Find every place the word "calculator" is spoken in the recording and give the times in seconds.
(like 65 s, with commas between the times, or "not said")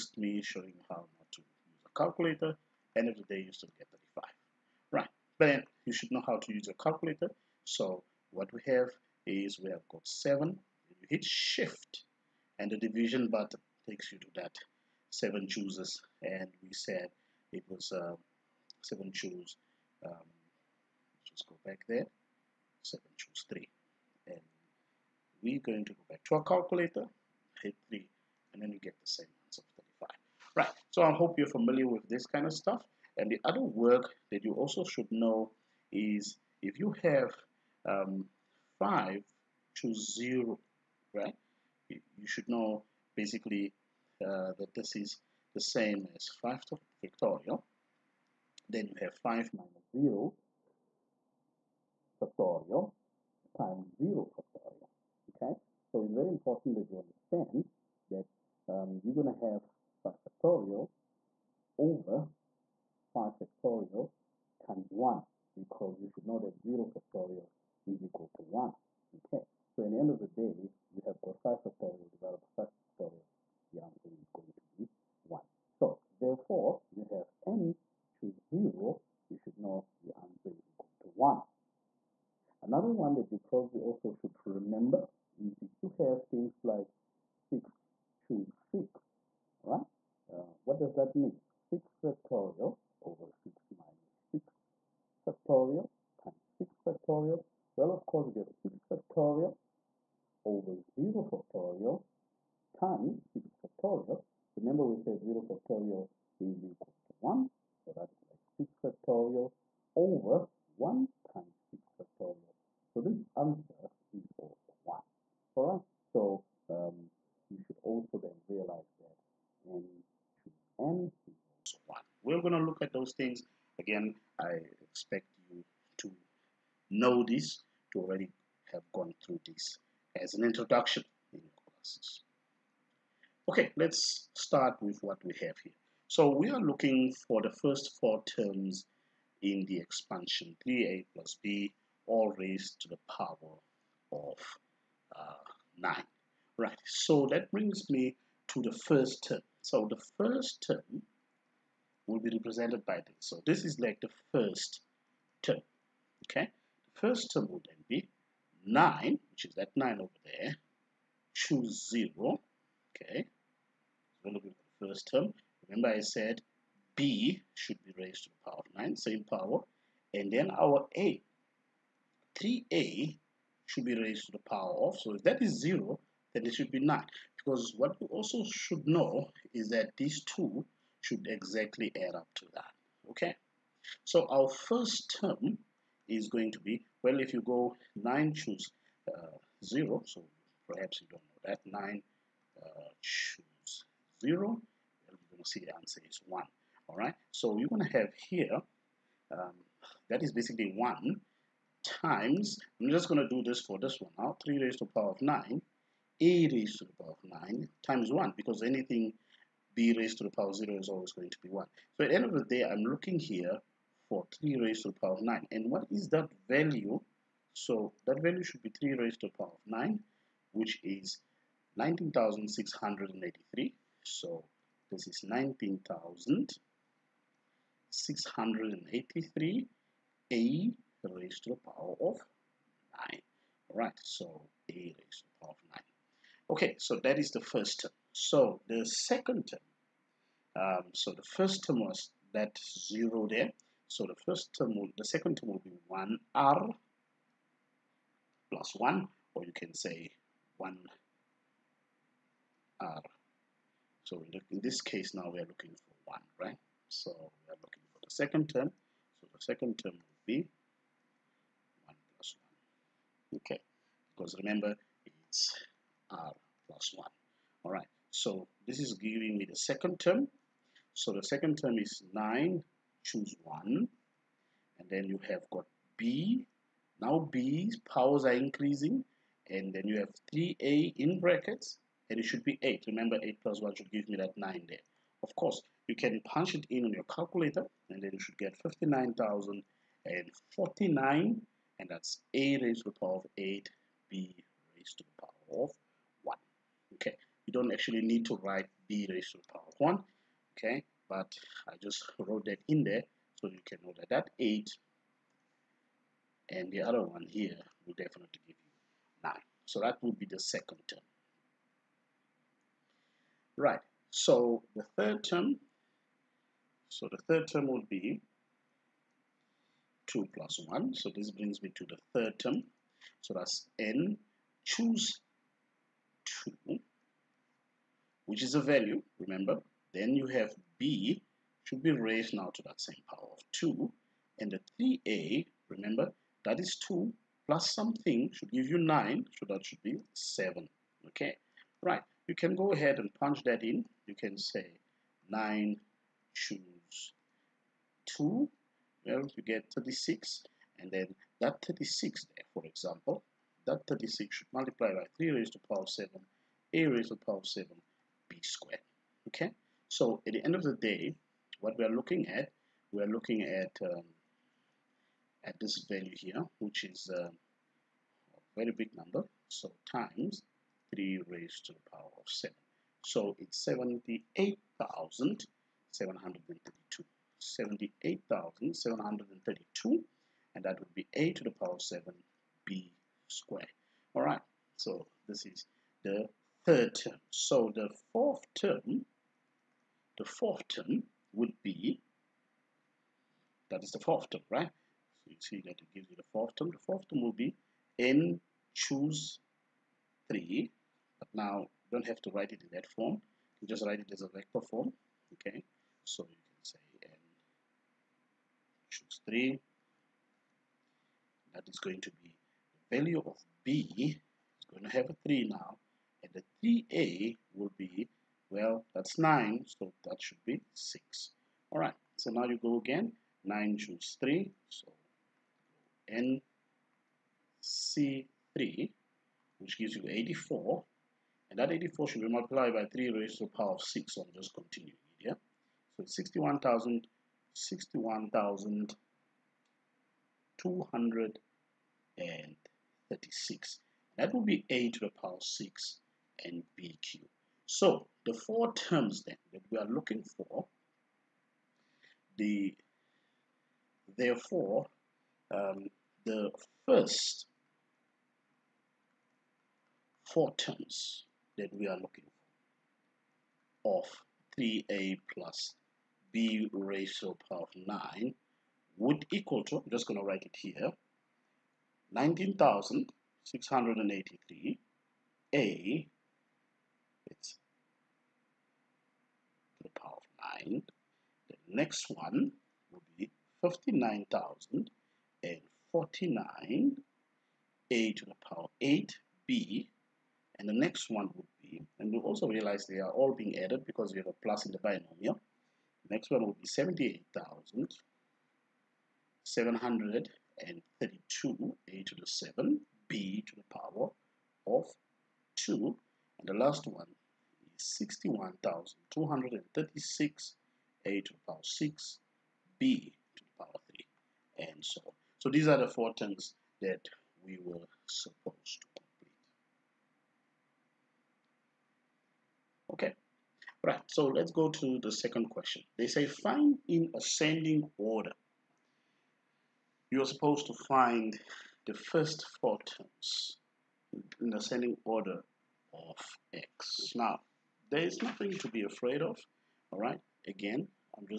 1 s, 6 s, 26 s, 287 s.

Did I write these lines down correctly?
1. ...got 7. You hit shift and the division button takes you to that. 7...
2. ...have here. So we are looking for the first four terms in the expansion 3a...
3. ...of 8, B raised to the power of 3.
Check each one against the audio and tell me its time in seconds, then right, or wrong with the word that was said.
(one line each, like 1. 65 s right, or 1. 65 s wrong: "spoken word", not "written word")
1. 9 s right
2. 135 s right
3. 293 s wrong: "1", not "3".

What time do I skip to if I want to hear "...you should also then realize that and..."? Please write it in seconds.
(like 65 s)
117 s.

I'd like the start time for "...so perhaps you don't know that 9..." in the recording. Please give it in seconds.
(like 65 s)
190 s.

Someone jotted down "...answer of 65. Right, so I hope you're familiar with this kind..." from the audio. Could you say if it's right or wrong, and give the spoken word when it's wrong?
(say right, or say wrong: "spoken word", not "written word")
wrong: "35", not "65".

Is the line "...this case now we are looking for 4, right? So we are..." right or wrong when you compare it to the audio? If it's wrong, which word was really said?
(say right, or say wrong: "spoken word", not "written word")
wrong: "1", not "4".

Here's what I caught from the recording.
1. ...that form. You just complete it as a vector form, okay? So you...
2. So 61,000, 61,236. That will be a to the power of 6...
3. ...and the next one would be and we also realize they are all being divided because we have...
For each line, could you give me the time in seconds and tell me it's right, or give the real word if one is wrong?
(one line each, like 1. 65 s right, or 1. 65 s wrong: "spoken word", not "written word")
1. 402 s wrong: "write", not "complete"
2. 435 s right
3. 490 s wrong: "added", not "divided".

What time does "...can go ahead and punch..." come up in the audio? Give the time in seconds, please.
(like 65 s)
342 s.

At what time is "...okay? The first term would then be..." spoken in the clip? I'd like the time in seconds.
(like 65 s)
156 s.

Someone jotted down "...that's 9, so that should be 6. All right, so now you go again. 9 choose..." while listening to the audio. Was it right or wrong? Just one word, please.
right.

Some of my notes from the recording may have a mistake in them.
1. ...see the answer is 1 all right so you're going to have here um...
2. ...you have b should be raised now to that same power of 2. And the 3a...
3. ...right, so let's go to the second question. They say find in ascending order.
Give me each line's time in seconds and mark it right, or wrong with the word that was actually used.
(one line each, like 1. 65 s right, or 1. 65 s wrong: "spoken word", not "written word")
1. 195 s right
2. 330 s right
3. 523 s right.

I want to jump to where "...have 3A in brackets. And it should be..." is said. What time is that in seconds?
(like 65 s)
279 s.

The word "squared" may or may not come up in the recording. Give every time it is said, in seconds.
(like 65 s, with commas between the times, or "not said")
358 s, 383 s.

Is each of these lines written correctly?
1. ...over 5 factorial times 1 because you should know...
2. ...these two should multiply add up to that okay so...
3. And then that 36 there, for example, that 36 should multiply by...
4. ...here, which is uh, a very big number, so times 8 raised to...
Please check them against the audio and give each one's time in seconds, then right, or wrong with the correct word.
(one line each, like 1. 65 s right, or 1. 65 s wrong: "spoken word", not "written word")
1. 61 s right
2. 179 s wrong: "exactly", not "multiply"
3. 350 s right
4. 366 s wrong: "3", not "8".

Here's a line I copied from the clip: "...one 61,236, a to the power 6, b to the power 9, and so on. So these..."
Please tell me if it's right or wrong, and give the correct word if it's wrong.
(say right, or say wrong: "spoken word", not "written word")
wrong: "3", not "9".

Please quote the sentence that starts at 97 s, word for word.
Well, of course, we get 6 factorial over 0 factorial times 6 factorial.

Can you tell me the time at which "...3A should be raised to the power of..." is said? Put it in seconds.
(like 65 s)
172 s.